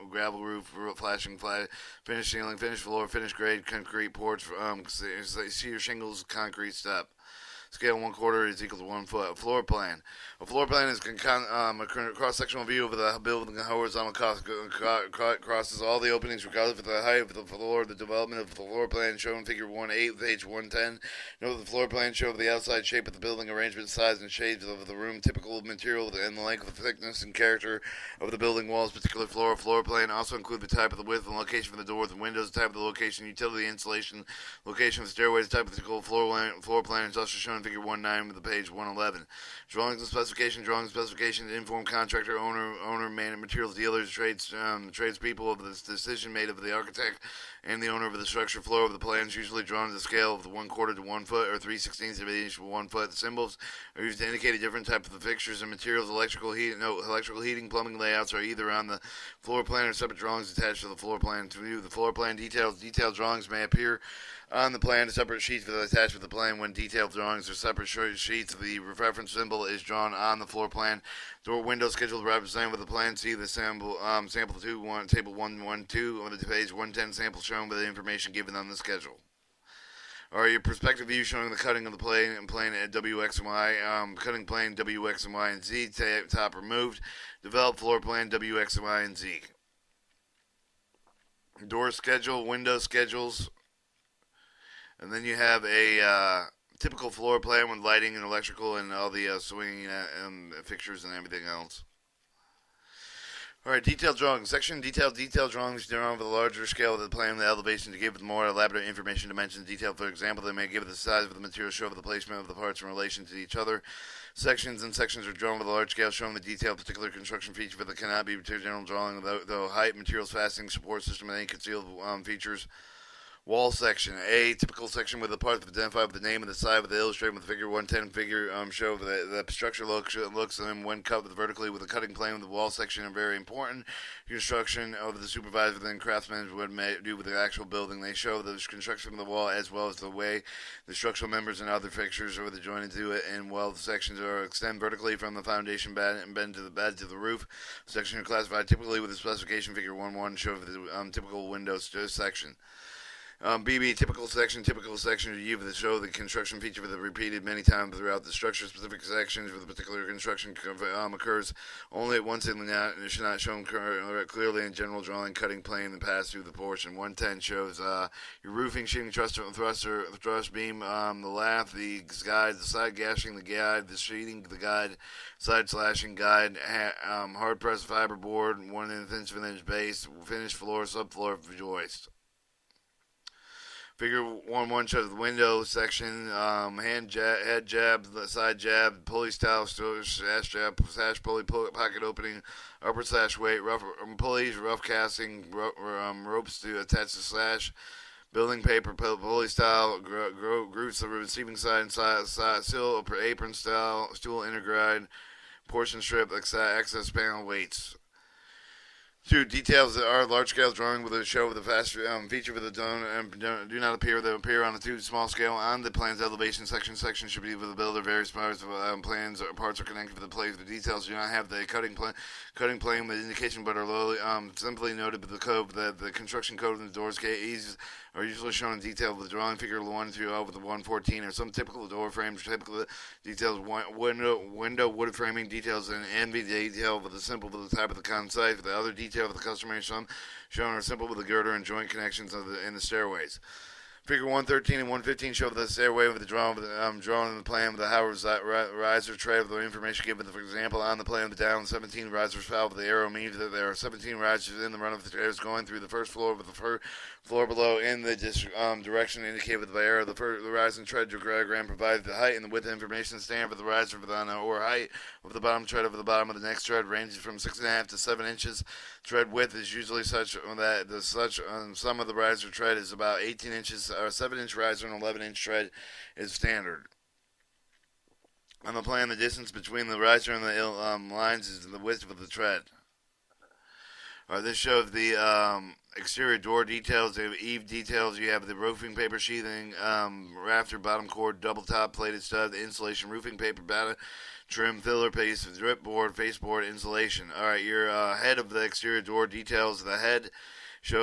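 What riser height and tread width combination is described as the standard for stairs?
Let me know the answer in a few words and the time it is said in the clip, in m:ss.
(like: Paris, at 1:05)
7-inch riser, 11-inch tread, at 4:34.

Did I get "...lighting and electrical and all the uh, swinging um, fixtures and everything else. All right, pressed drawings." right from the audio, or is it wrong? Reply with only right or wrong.
wrong.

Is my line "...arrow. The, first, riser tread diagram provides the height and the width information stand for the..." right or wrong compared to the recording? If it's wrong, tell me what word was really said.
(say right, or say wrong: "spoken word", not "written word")
right.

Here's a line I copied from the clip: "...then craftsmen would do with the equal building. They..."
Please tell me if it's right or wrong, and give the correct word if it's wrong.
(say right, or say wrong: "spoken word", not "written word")
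wrong: "actual", not "equal".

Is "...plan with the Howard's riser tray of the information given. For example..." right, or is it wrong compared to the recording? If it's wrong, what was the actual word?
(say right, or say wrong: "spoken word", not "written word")
right.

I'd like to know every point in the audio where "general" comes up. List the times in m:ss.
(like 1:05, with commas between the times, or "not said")
1:58, 2:44.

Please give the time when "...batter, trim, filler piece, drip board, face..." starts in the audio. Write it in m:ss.
4:53.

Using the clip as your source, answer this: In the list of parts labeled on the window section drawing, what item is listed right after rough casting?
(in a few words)
ropes.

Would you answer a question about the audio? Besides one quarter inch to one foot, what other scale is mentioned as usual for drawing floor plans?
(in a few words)
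3/16 inch to one foot.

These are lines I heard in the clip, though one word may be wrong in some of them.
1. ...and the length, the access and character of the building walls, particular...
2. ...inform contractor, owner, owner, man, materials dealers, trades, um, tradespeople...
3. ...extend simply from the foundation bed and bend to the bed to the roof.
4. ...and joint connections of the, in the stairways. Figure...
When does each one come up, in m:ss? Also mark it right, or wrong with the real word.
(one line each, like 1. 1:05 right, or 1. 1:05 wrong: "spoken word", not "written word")
1. 0:26 wrong: "thickness", not "access"
2. 0:41 right
3. 2:24 wrong: "vertically", not "simply"
4. 4:01 right.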